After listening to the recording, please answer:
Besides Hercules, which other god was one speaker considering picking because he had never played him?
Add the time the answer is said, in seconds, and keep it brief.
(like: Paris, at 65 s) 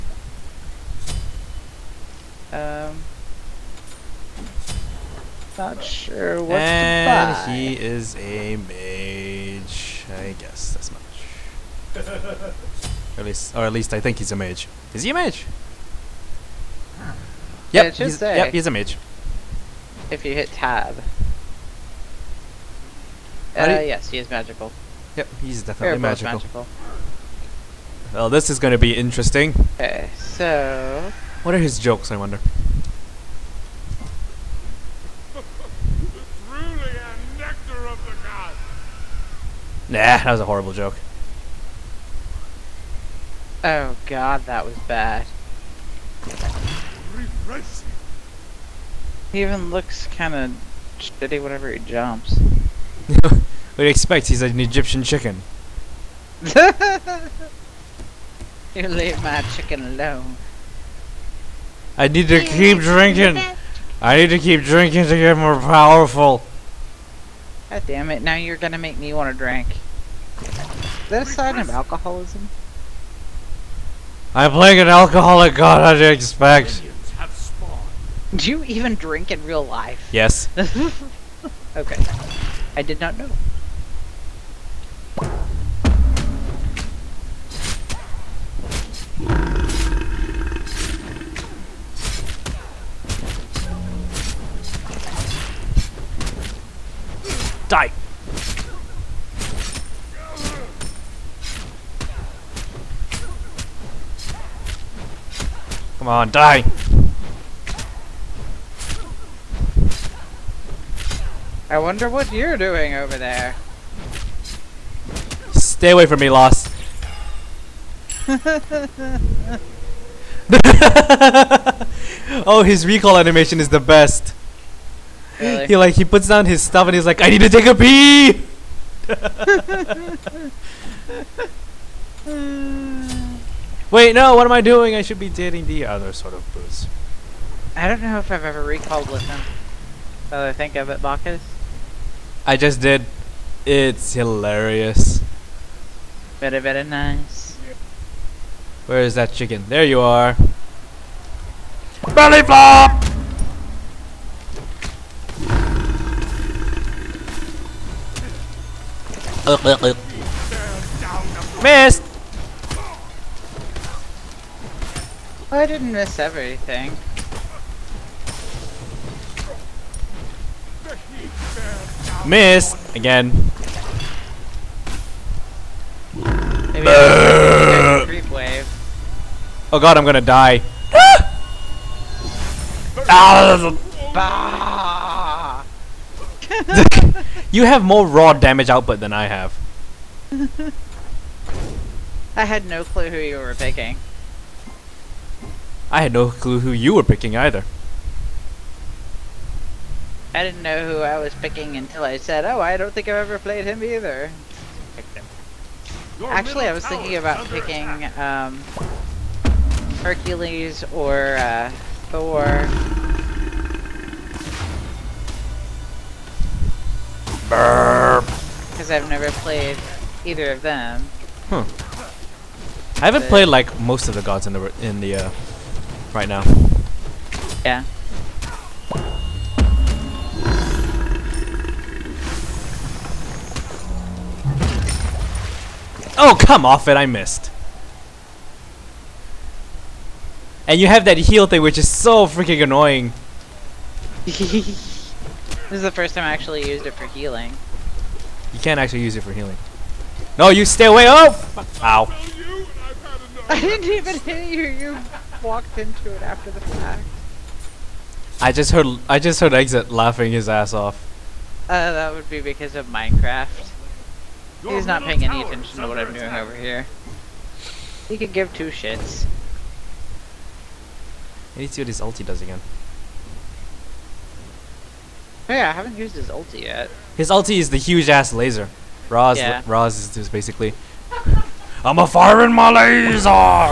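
Thor, at 212 s.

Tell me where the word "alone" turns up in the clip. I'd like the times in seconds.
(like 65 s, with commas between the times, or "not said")
59 s.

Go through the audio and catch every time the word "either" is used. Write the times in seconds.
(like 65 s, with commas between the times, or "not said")
197 s, 203 s, 220 s.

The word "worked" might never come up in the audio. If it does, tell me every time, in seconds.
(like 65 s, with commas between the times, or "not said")
not said.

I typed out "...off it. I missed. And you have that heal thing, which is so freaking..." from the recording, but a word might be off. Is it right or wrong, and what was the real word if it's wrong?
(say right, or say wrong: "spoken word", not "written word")
right.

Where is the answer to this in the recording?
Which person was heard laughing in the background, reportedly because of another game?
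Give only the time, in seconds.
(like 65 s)
259 s.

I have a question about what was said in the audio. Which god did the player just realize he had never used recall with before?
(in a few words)
Bacchus.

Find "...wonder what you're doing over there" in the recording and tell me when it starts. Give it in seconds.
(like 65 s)
111 s.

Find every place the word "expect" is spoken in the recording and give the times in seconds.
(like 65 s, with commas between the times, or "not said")
53 s, 76 s.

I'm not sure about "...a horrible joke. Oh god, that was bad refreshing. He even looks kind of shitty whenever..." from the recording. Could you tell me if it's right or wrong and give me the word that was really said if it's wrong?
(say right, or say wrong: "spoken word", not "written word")
right.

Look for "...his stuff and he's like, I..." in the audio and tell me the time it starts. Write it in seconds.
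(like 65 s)
126 s.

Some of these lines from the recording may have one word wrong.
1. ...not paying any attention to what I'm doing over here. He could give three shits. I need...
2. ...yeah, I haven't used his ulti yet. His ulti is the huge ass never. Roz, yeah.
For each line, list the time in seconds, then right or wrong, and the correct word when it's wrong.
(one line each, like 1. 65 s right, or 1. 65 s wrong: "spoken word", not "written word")
1. 264 s wrong: "two", not "three"
2. 275 s wrong: "laser", not "never".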